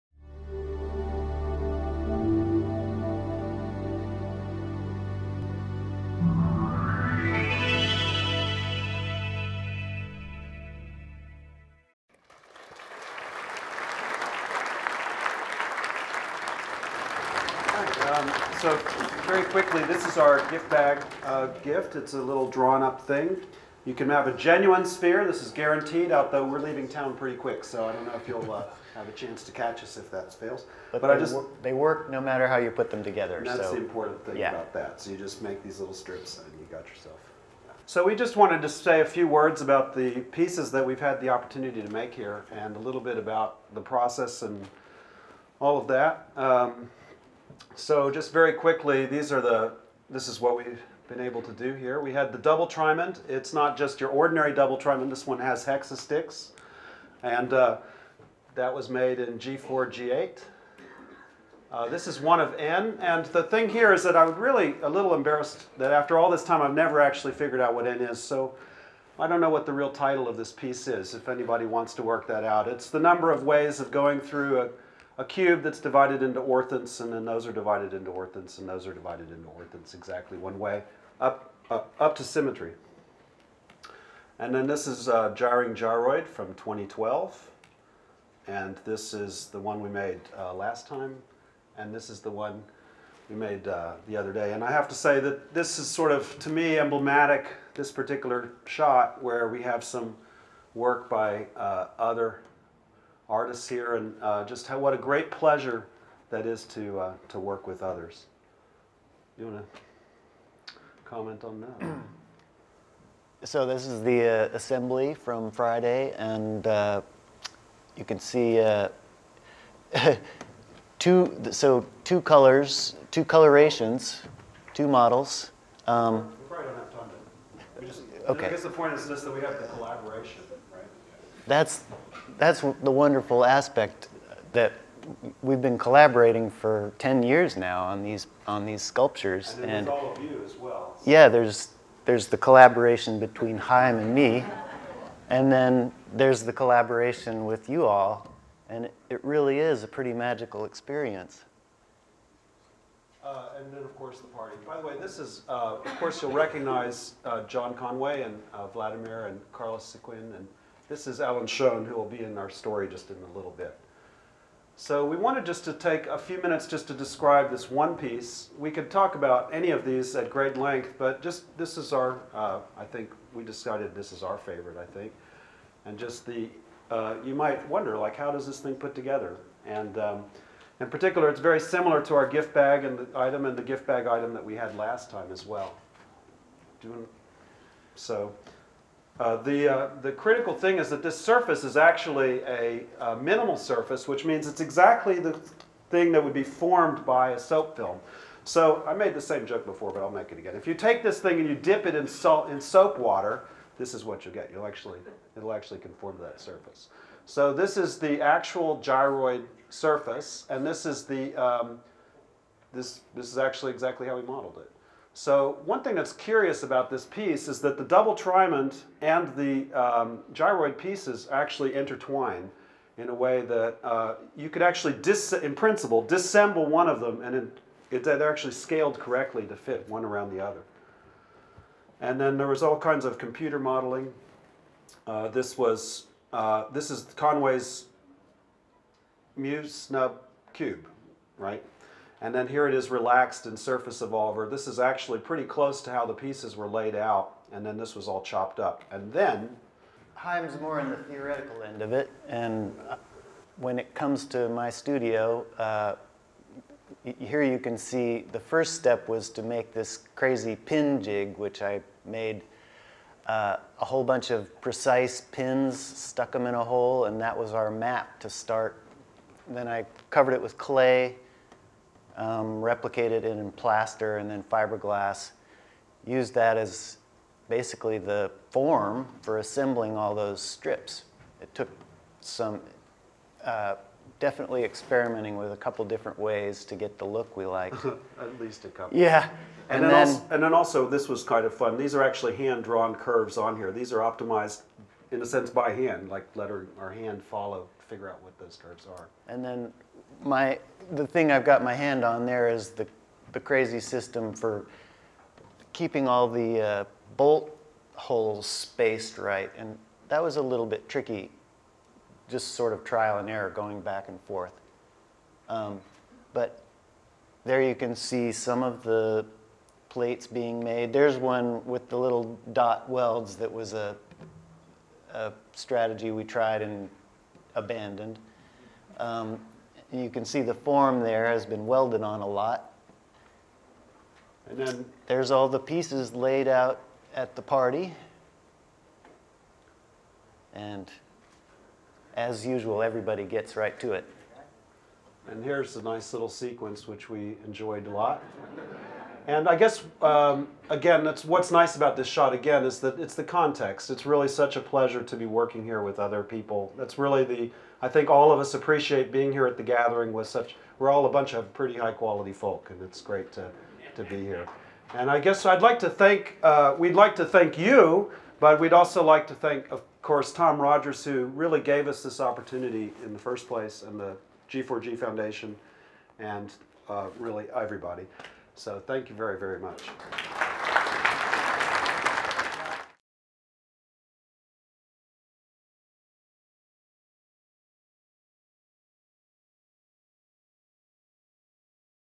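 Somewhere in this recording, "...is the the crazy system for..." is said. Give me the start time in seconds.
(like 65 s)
302 s.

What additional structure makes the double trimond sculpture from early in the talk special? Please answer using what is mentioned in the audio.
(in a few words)
hexastix.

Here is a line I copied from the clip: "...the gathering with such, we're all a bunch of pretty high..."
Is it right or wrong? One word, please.
right.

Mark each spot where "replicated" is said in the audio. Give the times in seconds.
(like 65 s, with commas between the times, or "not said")
272 s.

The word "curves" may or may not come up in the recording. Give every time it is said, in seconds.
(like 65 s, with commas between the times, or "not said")
292 s, 298 s.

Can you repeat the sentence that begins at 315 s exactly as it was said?
Um, but there you can see some of the plates being made.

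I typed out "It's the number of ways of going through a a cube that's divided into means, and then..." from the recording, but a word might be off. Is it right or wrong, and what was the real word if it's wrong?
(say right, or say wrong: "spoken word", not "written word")
wrong: "orthons", not "means".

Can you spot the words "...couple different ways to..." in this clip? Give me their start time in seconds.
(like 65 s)
285 s.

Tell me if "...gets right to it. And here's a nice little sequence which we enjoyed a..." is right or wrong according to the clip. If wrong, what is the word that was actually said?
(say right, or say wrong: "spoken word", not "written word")
right.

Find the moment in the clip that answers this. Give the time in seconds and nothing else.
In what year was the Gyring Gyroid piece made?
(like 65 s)
86 s.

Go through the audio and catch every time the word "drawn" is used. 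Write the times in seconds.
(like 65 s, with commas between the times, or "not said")
22 s, 292 s.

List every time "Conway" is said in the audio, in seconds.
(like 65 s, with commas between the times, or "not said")
157 s, 237 s.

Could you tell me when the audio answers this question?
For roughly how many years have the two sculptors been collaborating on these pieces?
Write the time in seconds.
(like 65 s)
136 s.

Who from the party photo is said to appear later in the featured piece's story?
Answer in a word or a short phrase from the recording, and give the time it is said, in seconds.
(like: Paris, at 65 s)
Alan Schoen, at 161 s.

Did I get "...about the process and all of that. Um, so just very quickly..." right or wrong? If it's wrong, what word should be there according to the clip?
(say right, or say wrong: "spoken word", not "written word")
right.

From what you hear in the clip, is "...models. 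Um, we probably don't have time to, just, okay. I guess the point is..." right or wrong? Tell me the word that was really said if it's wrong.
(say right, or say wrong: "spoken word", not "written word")
right.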